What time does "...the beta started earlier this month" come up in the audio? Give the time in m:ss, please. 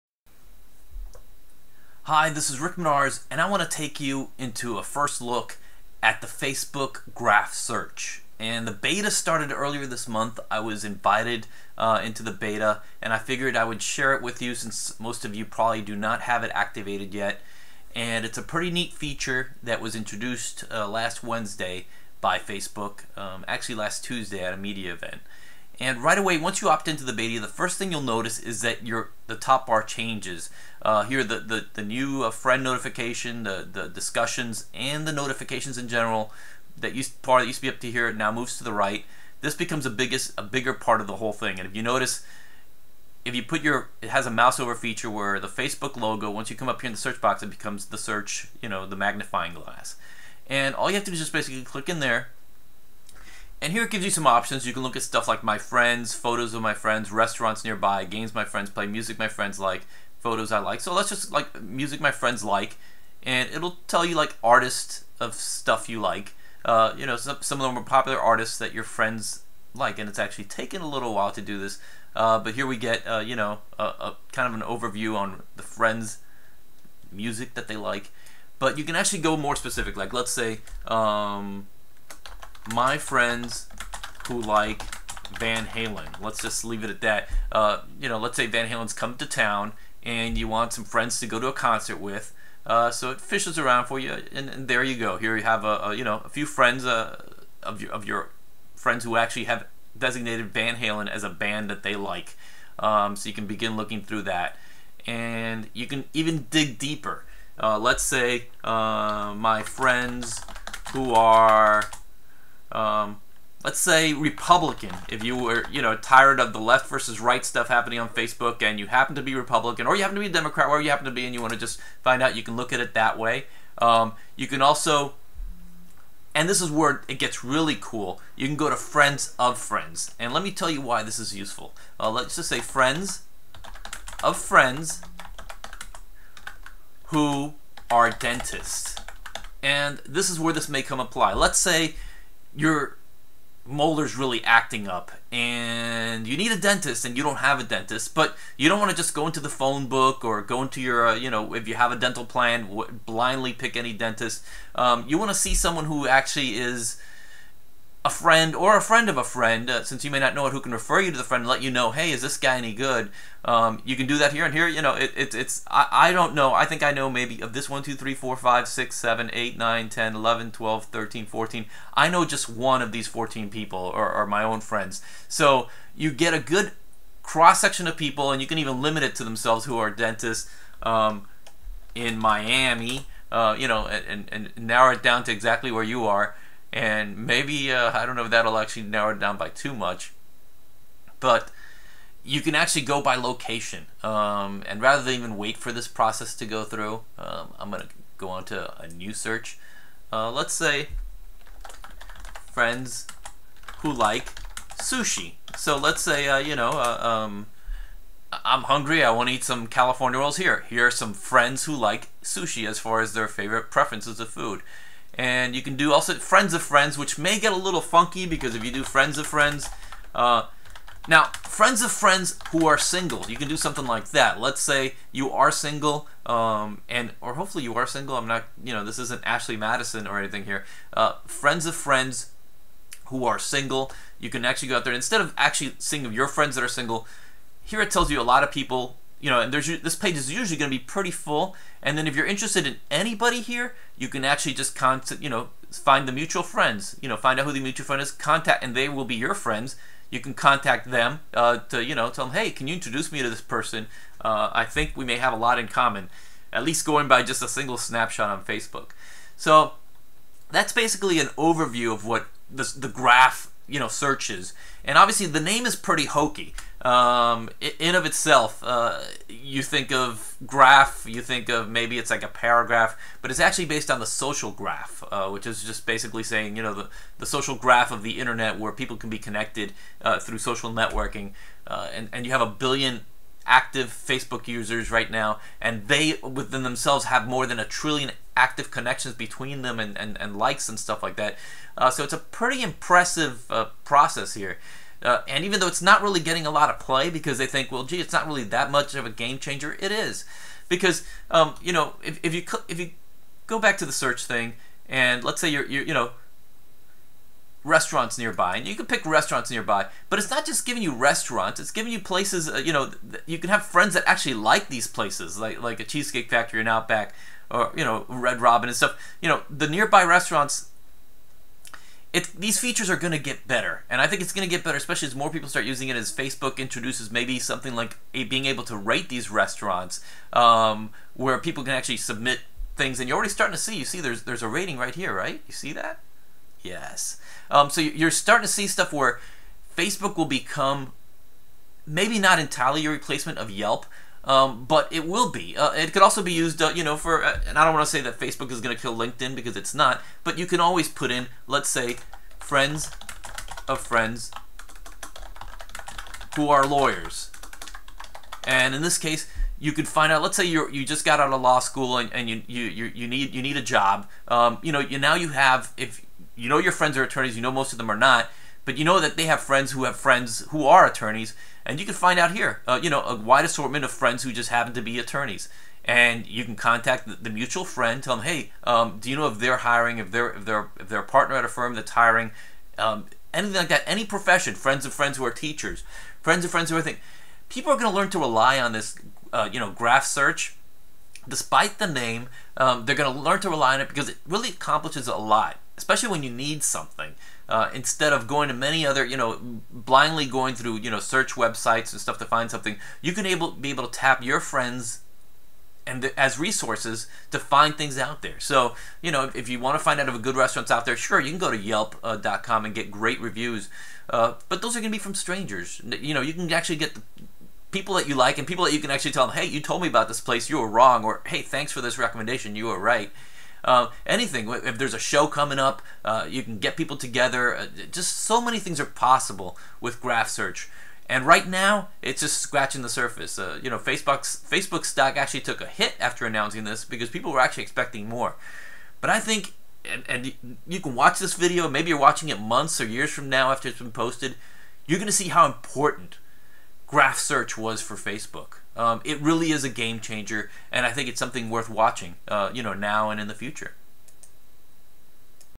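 0:08.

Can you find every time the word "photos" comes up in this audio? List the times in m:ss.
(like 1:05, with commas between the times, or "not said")
0:56, 1:00.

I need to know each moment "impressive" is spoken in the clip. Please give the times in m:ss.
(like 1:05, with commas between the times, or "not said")
4:52.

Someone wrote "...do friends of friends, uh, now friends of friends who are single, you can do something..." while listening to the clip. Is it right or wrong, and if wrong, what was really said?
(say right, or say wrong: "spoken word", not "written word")
right.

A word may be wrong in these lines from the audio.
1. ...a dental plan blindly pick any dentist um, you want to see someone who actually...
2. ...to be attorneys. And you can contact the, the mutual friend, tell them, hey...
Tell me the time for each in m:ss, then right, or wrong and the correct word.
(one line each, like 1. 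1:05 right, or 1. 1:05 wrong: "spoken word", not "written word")
1. 2:31 right
2. 6:14 right.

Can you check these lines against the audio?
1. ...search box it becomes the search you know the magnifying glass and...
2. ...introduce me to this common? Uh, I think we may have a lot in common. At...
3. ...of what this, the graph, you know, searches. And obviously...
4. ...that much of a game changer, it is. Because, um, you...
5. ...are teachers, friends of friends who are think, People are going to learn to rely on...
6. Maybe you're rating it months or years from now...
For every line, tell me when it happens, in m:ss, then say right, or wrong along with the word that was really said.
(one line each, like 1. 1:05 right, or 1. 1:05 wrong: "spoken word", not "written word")
1. 0:46 right
2. 4:12 wrong: "person", not "common"
3. 4:21 right
4. 4:58 right
5. 6:25 right
6. 7:21 wrong: "watching", not "rating".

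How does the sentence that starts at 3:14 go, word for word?
Um, and rather than even wait for this process to go through, um, I'm going to go on to a new search.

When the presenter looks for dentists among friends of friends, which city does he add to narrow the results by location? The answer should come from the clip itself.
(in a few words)
Miami.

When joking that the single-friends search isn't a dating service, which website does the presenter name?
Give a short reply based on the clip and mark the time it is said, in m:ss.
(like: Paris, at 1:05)
Ashley Madison, at 3:49.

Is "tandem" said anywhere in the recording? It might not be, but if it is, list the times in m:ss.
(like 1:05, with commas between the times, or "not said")
not said.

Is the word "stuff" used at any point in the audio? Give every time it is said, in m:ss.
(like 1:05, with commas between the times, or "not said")
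0:55, 1:05, 1:57, 4:50, 5:18, 5:38, 6:41.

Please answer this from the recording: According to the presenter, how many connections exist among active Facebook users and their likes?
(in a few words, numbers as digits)
more than a trillion.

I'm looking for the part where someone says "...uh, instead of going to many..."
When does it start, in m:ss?
6:37.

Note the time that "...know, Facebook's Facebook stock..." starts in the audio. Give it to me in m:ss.
7:13.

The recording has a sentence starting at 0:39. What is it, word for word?
This becomes a biggest a bigger part of the whole thing.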